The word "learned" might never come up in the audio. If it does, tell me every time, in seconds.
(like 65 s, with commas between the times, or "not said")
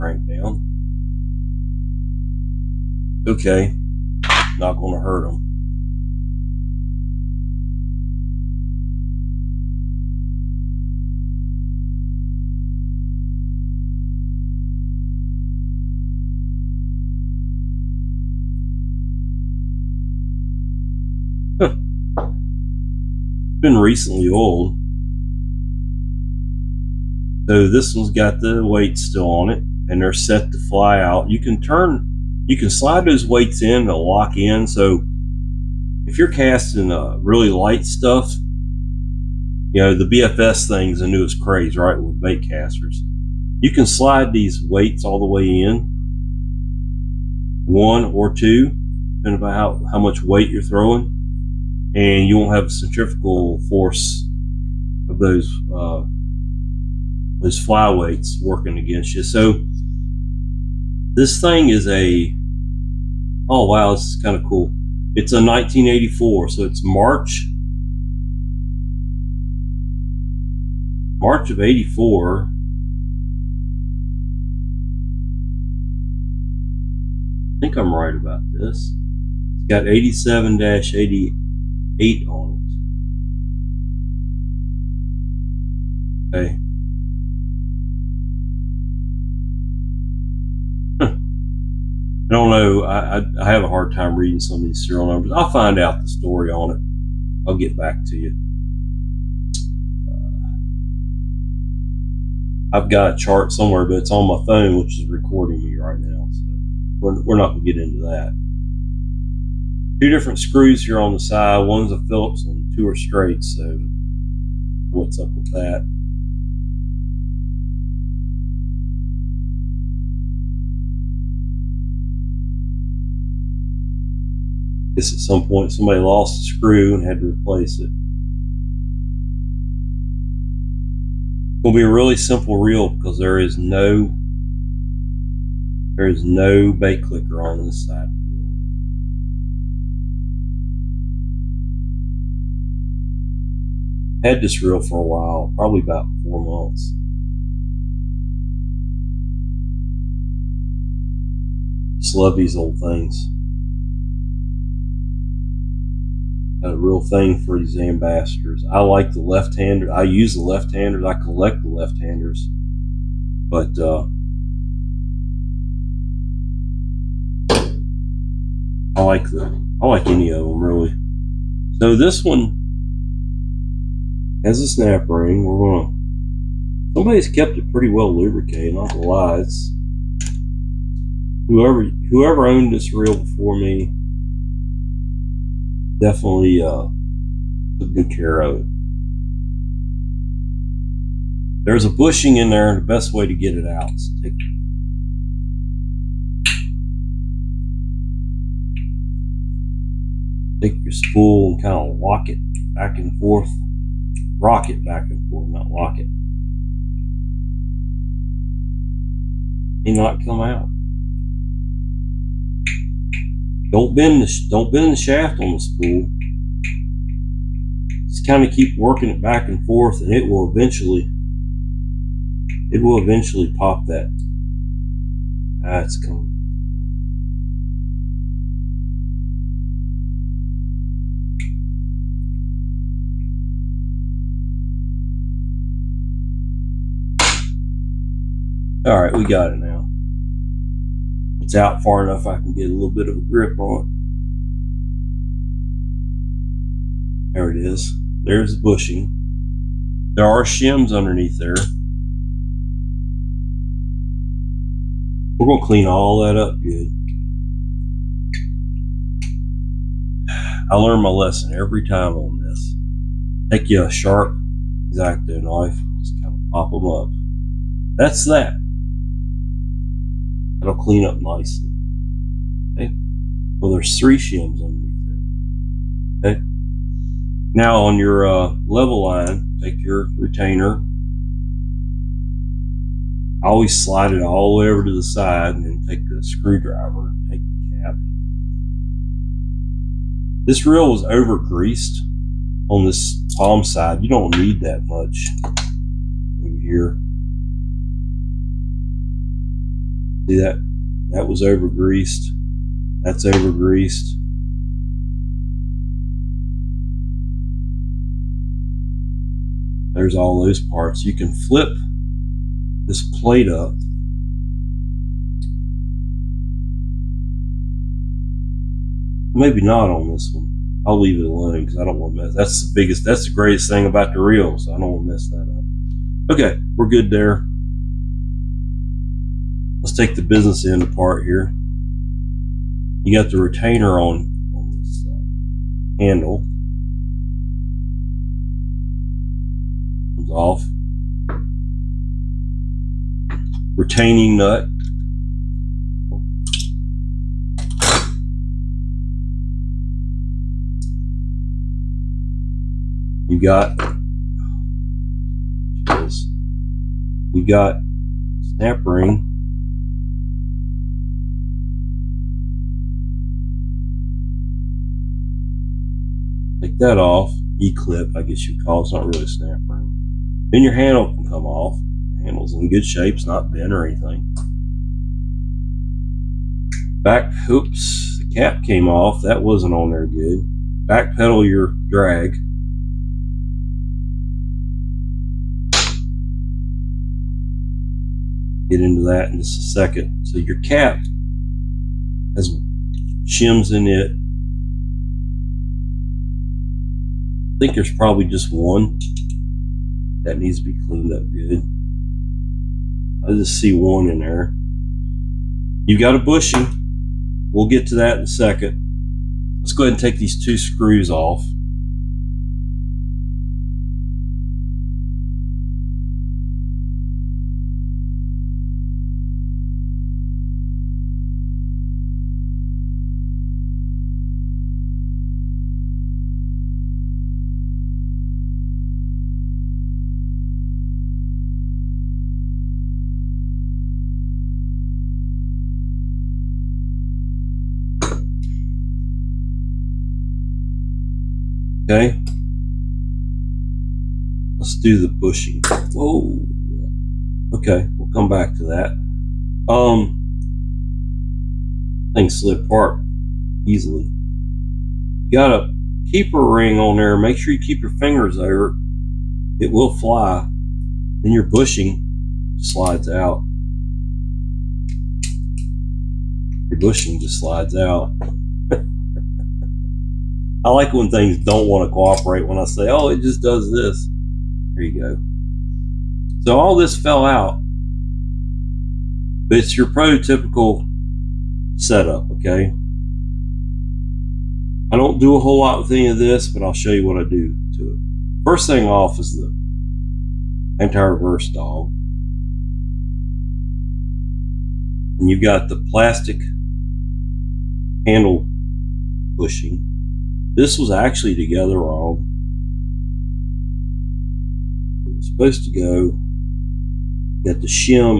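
260 s.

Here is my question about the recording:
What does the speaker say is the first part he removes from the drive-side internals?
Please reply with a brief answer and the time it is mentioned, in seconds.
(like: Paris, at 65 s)
Anti-reverse dog, at 490 s.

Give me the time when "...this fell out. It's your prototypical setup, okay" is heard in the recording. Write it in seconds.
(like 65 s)
476 s.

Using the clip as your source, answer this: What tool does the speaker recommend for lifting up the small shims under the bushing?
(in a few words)
X-Acto knife.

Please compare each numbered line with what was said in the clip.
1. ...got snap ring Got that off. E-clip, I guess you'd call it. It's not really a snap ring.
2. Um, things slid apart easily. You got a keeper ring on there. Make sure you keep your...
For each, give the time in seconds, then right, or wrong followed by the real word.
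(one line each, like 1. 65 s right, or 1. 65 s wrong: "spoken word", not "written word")
1. 357 s wrong: "Take", not "Got"
2. 449 s right.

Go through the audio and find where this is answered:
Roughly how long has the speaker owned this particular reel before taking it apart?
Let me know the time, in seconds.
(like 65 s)
145 s.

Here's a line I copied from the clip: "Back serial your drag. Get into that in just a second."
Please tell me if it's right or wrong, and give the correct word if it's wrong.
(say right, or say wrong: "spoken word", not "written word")
wrong: "pedal", not "serial".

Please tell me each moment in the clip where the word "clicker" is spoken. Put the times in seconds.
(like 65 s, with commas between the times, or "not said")
137 s.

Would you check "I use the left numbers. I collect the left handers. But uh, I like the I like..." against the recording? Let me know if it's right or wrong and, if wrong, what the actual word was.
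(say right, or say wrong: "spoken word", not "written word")
wrong: "handers", not "numbers".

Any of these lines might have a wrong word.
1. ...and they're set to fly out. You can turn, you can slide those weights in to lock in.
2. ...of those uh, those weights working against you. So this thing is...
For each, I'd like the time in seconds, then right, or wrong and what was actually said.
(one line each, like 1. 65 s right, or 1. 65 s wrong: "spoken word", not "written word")
1. 29 s right
2. 55 s wrong: "flyweights", not "weights".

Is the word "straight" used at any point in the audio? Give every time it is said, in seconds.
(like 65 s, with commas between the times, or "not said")
112 s.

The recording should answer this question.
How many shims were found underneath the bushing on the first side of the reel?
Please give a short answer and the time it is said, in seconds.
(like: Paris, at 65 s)
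3, at 273 s.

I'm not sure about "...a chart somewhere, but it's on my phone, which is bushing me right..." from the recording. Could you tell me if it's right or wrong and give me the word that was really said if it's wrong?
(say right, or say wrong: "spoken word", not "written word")
wrong: "recording", not "bushing".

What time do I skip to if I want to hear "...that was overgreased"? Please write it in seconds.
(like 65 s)
301 s.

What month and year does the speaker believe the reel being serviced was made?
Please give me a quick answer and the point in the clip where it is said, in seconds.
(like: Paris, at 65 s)
March 1984, at 71 s.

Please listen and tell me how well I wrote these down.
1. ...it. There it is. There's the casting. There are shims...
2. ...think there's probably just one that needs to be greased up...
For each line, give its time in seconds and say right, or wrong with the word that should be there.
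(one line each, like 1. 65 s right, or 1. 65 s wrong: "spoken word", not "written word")
1. 243 s wrong: "bushing", not "casting"
2. 397 s wrong: "cleaned", not "greased".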